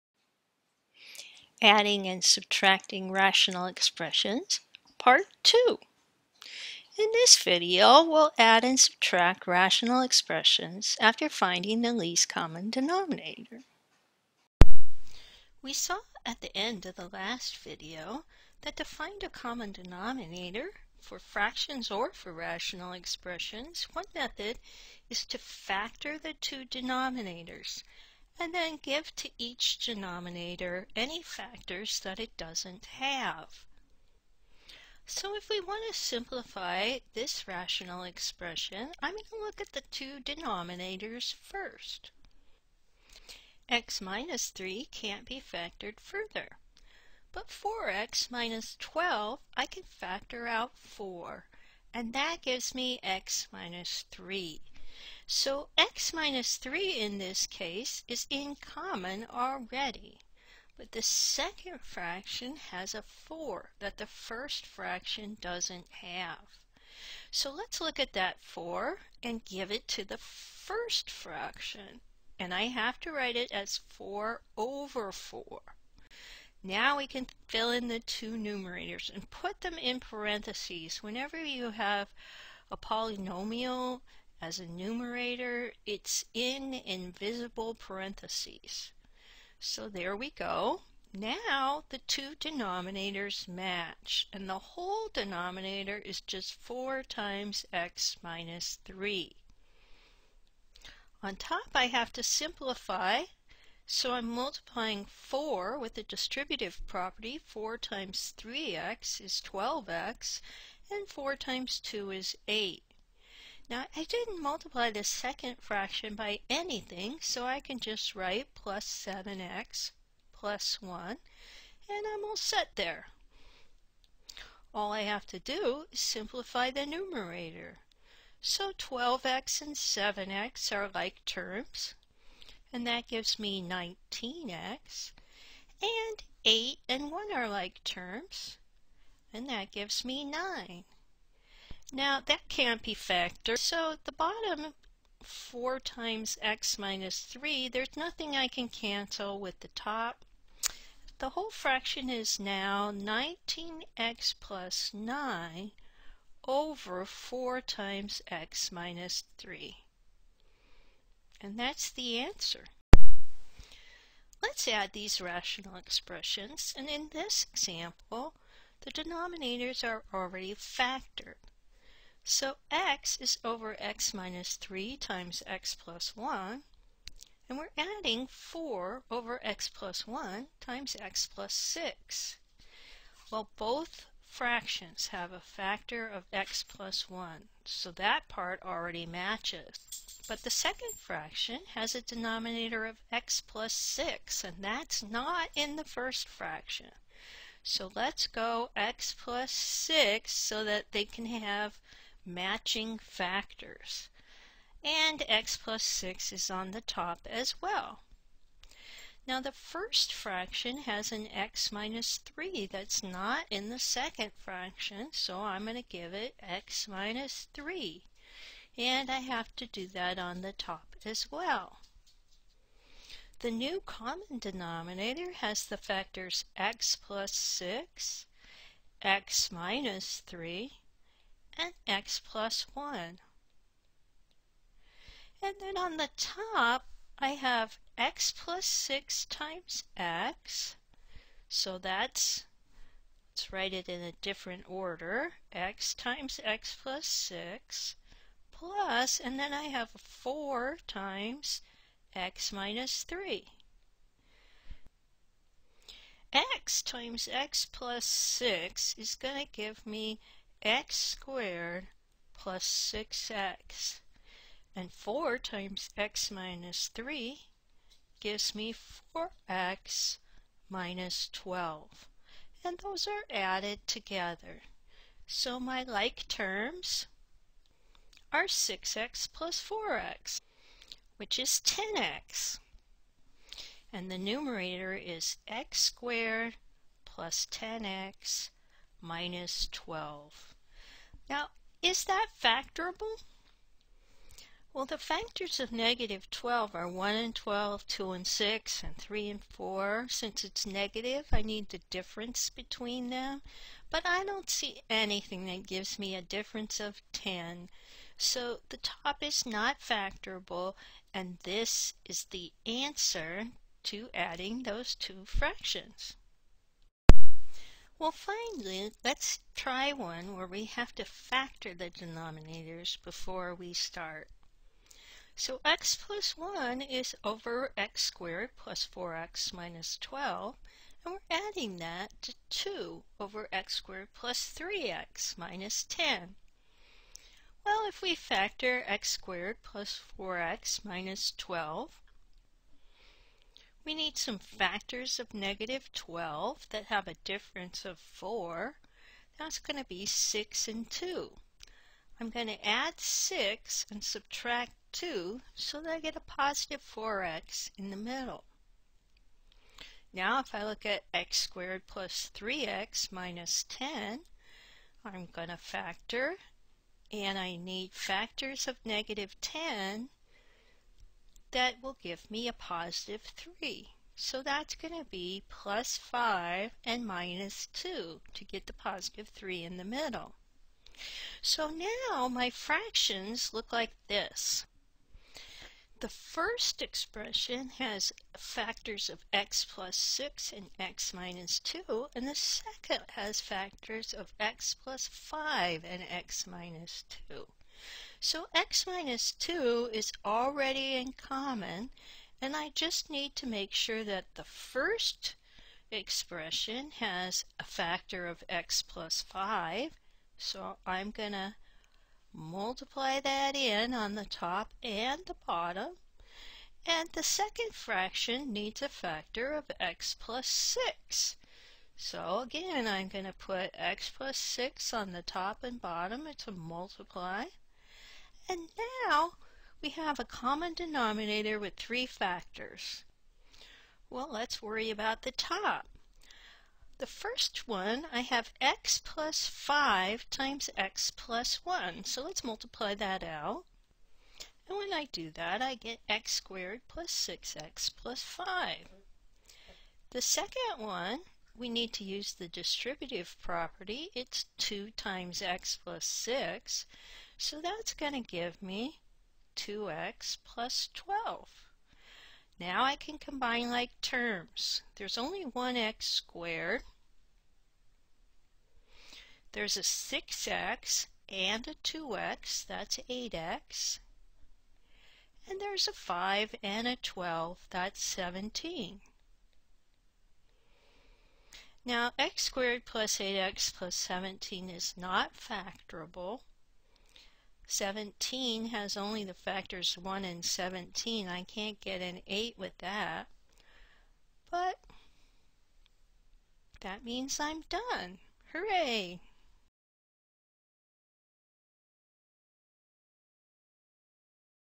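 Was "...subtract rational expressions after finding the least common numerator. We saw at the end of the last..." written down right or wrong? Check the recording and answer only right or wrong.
wrong.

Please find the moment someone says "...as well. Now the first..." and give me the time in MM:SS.
03:27.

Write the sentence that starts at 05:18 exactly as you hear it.
Well, finally, let's try one where we have to factor the denominators before we start.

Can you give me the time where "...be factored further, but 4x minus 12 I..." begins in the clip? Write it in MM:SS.
00:45.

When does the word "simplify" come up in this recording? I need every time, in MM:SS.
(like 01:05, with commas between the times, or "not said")
00:35, 01:42, 02:06.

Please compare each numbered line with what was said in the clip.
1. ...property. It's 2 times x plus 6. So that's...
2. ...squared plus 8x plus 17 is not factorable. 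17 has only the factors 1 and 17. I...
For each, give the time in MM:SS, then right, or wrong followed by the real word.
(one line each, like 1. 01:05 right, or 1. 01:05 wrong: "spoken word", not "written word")
1. 07:33 right
2. 08:02 right.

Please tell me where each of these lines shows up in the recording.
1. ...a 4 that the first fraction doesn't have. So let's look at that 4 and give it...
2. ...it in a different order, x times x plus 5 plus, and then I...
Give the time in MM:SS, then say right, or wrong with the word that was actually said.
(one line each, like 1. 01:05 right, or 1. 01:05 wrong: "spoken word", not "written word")
1. 01:02 right
2. 04:03 wrong: "6", not "5".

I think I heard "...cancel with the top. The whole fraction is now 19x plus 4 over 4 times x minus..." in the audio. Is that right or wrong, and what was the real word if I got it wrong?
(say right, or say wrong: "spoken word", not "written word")
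wrong: "9", not "4".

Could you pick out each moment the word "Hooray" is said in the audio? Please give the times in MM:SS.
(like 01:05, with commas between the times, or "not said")
08:18.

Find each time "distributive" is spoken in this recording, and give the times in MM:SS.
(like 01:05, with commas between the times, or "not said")
01:46, 07:32.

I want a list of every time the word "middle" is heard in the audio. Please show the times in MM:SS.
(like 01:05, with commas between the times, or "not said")
05:57, 06:19.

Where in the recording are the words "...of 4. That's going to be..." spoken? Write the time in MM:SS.
05:47.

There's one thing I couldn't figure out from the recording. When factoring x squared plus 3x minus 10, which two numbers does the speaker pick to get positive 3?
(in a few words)
plus 5 and minus 2.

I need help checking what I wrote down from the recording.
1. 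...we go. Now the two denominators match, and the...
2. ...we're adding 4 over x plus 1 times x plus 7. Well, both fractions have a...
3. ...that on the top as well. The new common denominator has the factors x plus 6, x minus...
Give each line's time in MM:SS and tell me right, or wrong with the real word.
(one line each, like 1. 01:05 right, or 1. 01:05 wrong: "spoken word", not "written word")
1. 01:30 right
2. 02:57 wrong: "6", not "7"
3. 03:39 right.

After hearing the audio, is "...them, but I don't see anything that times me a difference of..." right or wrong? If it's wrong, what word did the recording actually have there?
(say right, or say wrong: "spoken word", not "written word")
wrong: "gives", not "times".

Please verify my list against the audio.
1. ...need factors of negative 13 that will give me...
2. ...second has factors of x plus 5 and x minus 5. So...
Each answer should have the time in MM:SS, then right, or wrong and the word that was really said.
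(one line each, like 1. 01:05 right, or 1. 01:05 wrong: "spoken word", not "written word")
1. 06:07 wrong: "10", not "13"
2. 06:32 wrong: "2", not "5".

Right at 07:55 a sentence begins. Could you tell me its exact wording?
And there's a 5 and a 12, that's 17.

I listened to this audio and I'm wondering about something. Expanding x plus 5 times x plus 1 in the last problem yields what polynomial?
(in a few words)
x squared plus 6x plus 5.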